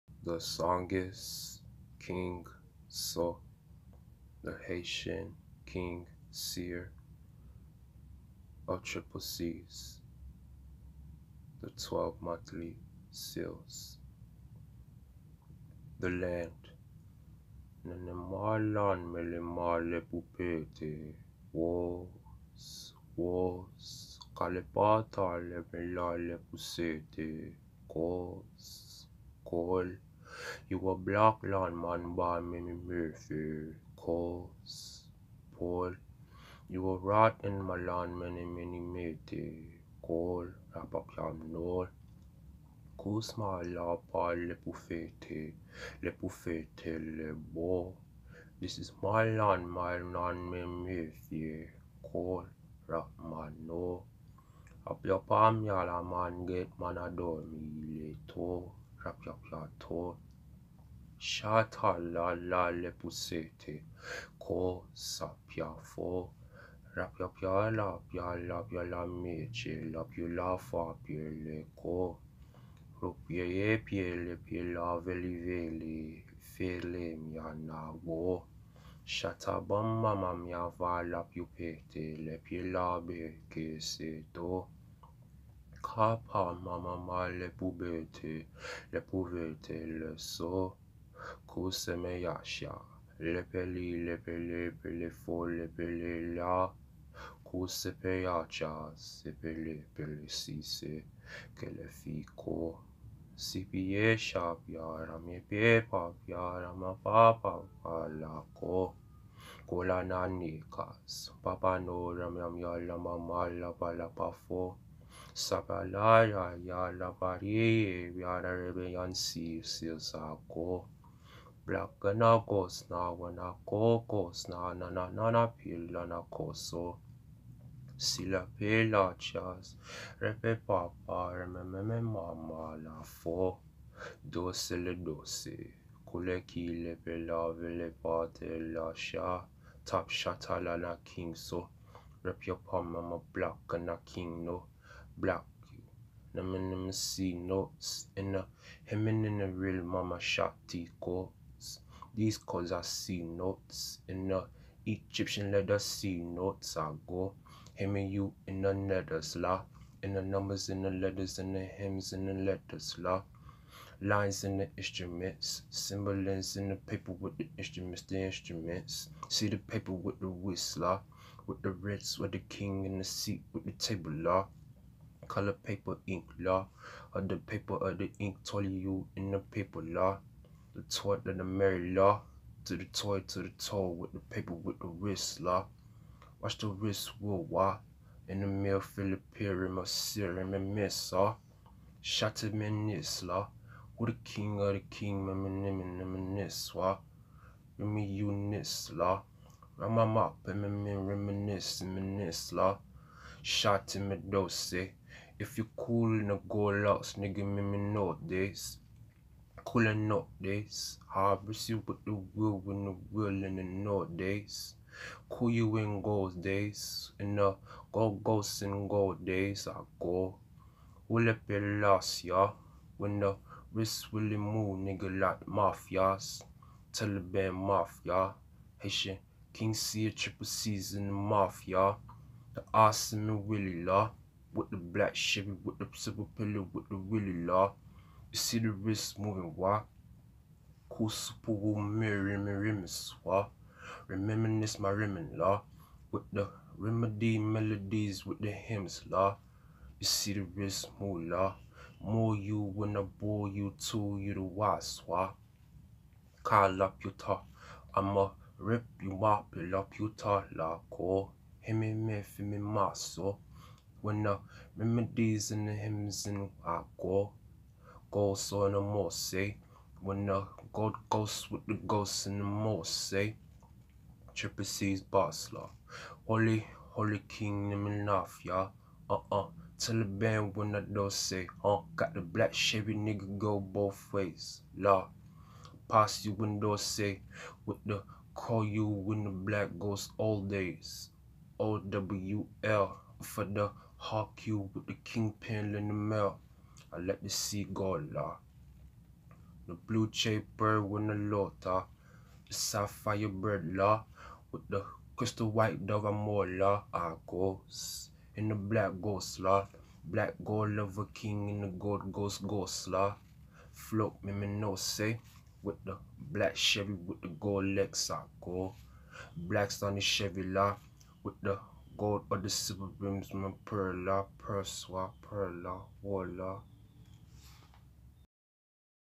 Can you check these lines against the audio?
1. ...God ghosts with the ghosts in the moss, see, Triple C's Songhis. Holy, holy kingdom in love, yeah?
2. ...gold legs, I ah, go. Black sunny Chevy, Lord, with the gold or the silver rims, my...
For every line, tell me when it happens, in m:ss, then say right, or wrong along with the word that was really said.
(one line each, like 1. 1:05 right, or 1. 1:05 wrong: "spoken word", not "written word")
1. 4:30 wrong: "Basler", not "Songhis"
2. 5:17 right.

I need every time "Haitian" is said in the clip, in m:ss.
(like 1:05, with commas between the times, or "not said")
0:04, 3:48.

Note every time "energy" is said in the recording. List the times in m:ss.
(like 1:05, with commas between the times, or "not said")
not said.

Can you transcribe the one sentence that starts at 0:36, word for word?
You will rot in my land, many, many, many call, rapaklam, no.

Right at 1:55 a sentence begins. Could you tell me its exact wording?
Sapalaya yala pari, yara rebeyansi silsako.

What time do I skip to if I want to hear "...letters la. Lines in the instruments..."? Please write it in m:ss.
2:42.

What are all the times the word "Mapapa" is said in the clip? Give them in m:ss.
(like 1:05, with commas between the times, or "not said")
1:46.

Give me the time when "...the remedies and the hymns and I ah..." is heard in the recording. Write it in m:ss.
4:24.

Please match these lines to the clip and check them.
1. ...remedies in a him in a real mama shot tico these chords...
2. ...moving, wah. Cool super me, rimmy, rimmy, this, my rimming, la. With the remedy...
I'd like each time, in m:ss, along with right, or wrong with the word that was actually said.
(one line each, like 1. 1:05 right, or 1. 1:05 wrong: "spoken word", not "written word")
1. 2:27 wrong: "notes", not "remedies"
2. 3:59 right.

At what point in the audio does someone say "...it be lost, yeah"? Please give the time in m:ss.
3:41.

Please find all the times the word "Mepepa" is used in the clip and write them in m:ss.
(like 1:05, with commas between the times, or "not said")
1:45.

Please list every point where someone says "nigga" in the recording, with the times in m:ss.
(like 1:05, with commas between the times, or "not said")
3:27, 3:44, 4:42.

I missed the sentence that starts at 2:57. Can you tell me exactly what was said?
or the paper or the ink told you in the paper la.